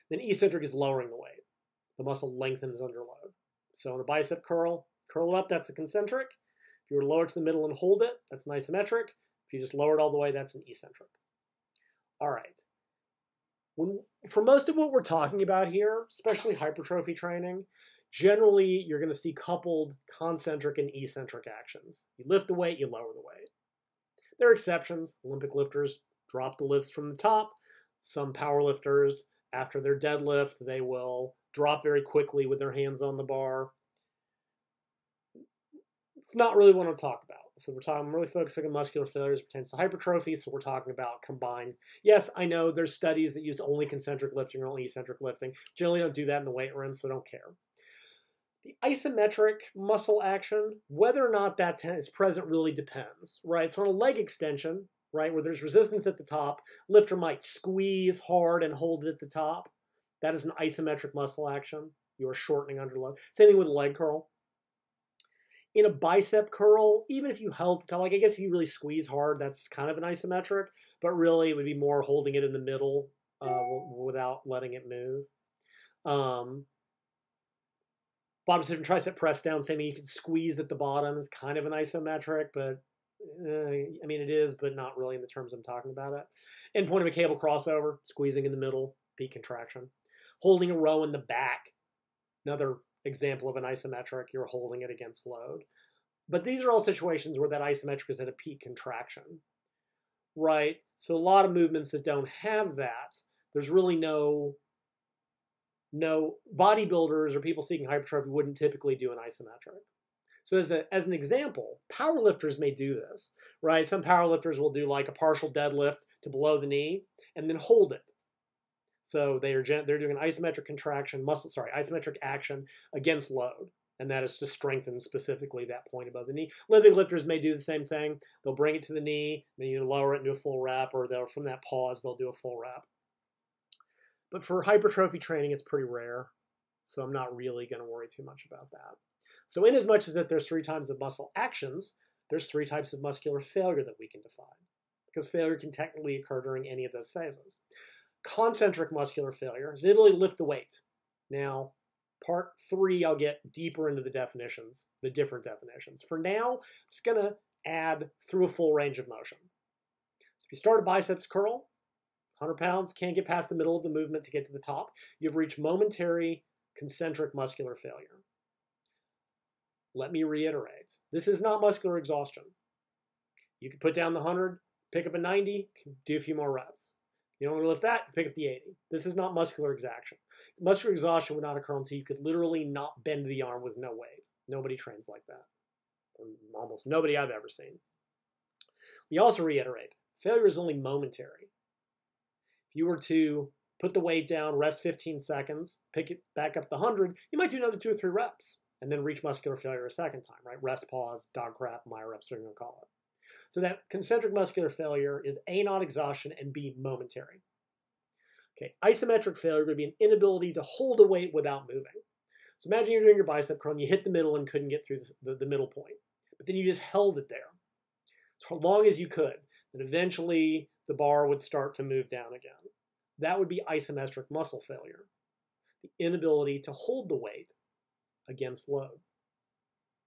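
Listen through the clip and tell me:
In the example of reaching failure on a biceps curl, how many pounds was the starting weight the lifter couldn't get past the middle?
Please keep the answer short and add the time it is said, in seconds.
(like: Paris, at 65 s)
100, at 162 s.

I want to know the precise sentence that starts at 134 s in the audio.
But for hypertrophy training, it's pretty rare.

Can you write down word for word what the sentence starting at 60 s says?
That is an isometric muscle action.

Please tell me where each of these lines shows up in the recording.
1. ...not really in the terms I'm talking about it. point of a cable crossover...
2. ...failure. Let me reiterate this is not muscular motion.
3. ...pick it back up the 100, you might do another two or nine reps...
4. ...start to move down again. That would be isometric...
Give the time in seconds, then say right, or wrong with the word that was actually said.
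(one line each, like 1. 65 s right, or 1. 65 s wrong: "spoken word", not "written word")
1. 84 s right
2. 167 s wrong: "exhaustion", not "motion"
3. 195 s wrong: "three", not "nine"
4. 221 s right.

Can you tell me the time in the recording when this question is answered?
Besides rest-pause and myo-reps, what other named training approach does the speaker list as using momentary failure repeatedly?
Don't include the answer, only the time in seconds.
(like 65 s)
201 s.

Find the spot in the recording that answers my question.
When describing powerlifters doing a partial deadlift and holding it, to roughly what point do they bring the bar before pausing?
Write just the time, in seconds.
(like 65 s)
116 s.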